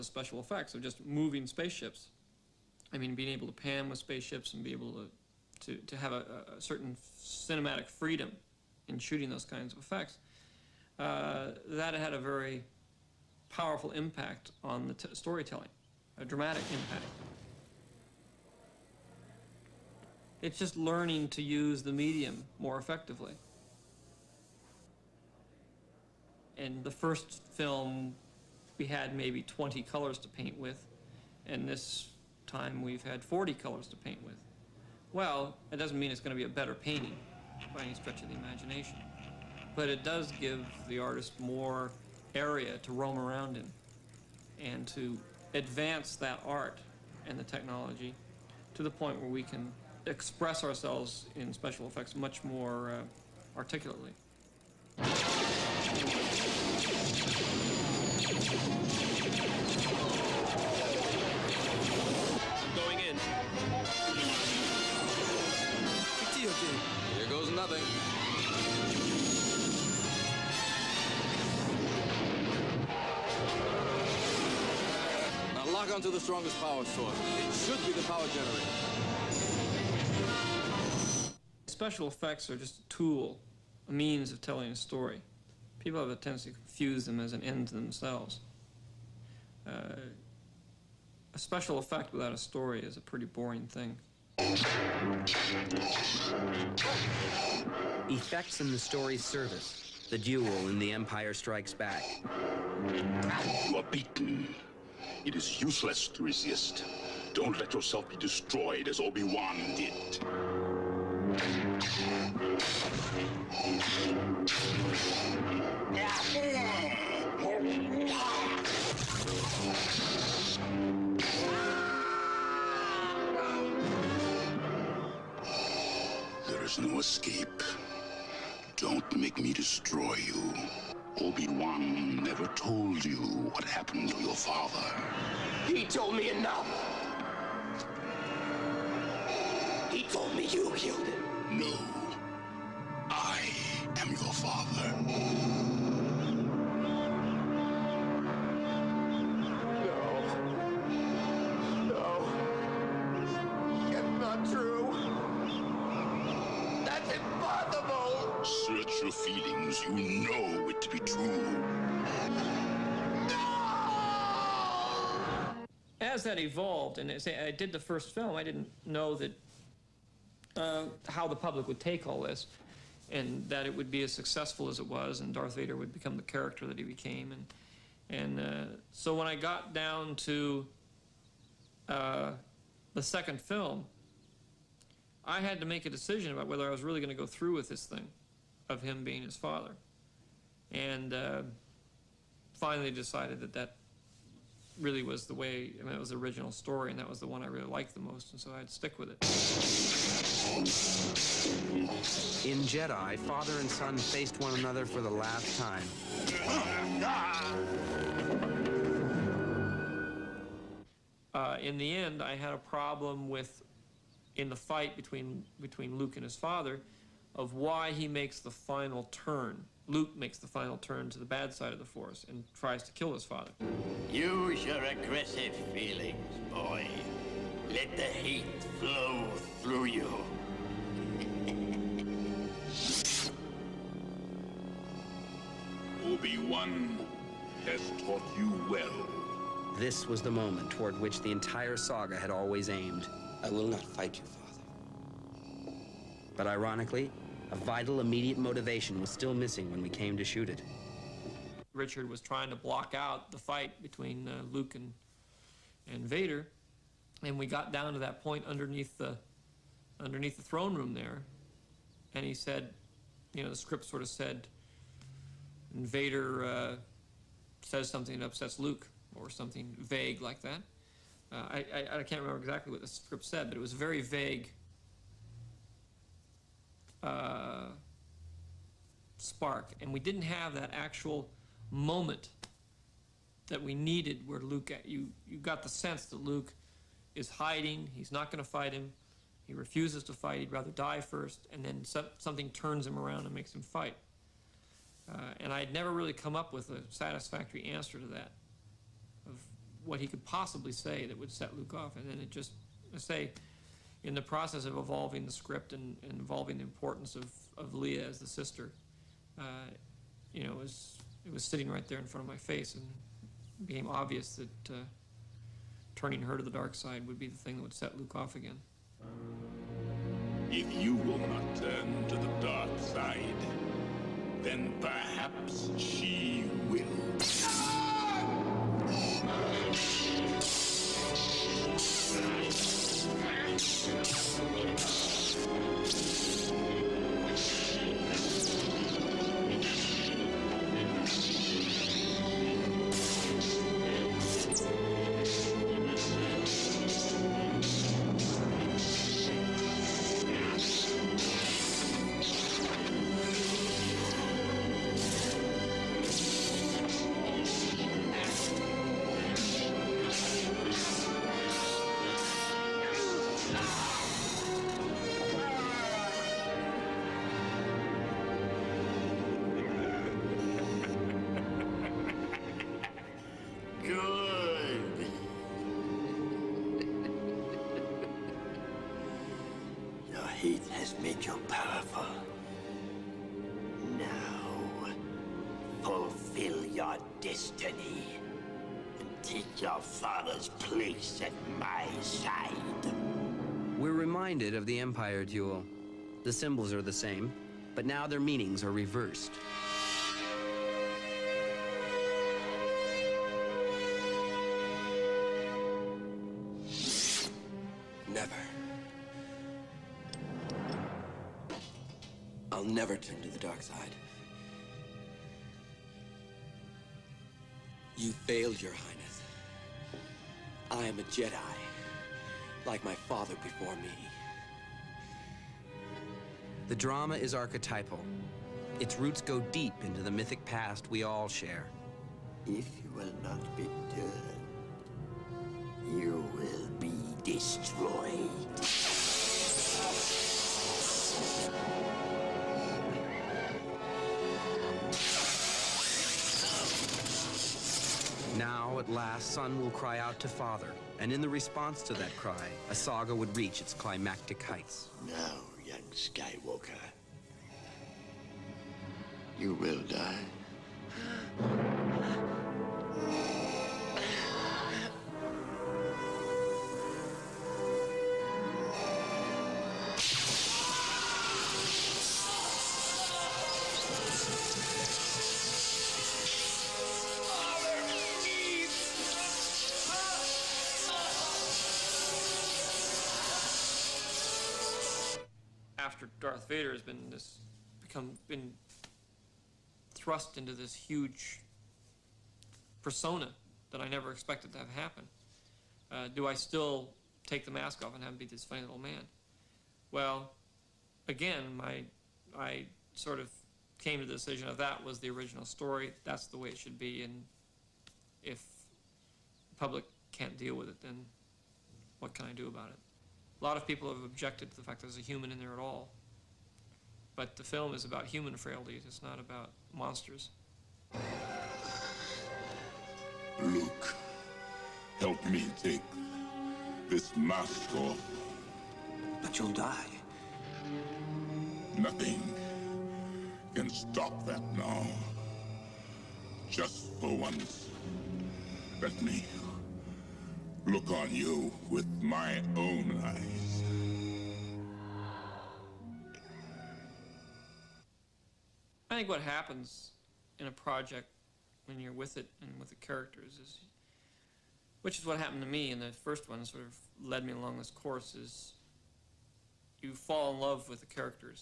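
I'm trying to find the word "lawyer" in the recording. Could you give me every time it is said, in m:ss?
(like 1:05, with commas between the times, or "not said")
not said.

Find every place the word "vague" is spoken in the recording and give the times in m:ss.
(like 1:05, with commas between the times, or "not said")
4:29, 4:34.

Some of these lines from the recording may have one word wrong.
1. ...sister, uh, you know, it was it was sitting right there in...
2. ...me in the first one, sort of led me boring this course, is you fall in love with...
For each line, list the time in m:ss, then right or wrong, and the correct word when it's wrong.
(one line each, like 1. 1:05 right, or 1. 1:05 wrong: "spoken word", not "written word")
1. 5:08 right
2. 9:15 wrong: "along", not "boring".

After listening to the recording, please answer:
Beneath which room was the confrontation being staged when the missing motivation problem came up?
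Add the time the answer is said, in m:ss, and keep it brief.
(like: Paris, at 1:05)
The throne room, at 4:20.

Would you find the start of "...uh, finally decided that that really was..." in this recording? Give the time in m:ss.
3:11.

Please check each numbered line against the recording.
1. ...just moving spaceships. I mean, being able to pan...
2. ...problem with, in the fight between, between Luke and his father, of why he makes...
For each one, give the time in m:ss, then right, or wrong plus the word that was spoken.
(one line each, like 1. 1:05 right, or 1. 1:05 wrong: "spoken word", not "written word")
1. 0:00 right
2. 3:32 right.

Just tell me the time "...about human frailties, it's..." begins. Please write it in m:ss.
8:37.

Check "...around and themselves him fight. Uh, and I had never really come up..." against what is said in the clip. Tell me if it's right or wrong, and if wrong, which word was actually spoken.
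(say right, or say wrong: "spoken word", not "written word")
wrong: "makes", not "themselves".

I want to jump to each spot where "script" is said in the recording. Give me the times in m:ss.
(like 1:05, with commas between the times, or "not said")
4:23, 4:32, 5:05.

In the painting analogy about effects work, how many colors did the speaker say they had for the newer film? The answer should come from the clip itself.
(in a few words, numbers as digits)
40.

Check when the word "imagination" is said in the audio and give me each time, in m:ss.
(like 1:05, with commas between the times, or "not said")
0:38.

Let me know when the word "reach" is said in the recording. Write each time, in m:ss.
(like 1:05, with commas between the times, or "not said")
7:33.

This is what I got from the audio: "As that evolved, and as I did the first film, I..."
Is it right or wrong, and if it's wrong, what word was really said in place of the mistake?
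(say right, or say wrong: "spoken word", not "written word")
right.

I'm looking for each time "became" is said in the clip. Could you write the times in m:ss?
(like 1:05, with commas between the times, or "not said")
2:56, 5:13.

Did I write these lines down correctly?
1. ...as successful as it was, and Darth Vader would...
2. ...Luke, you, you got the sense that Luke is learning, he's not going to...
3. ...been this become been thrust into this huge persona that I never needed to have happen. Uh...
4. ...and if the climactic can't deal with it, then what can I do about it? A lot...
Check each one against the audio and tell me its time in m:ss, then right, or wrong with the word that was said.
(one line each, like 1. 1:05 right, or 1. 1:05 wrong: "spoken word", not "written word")
1. 2:54 right
2. 4:44 wrong: "hiding", not "learning"
3. 8:06 wrong: "expected", not "needed"
4. 8:27 wrong: "public", not "climactic".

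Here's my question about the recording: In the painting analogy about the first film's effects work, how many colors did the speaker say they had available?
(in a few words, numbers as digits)
20.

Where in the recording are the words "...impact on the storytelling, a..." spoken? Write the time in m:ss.
0:13.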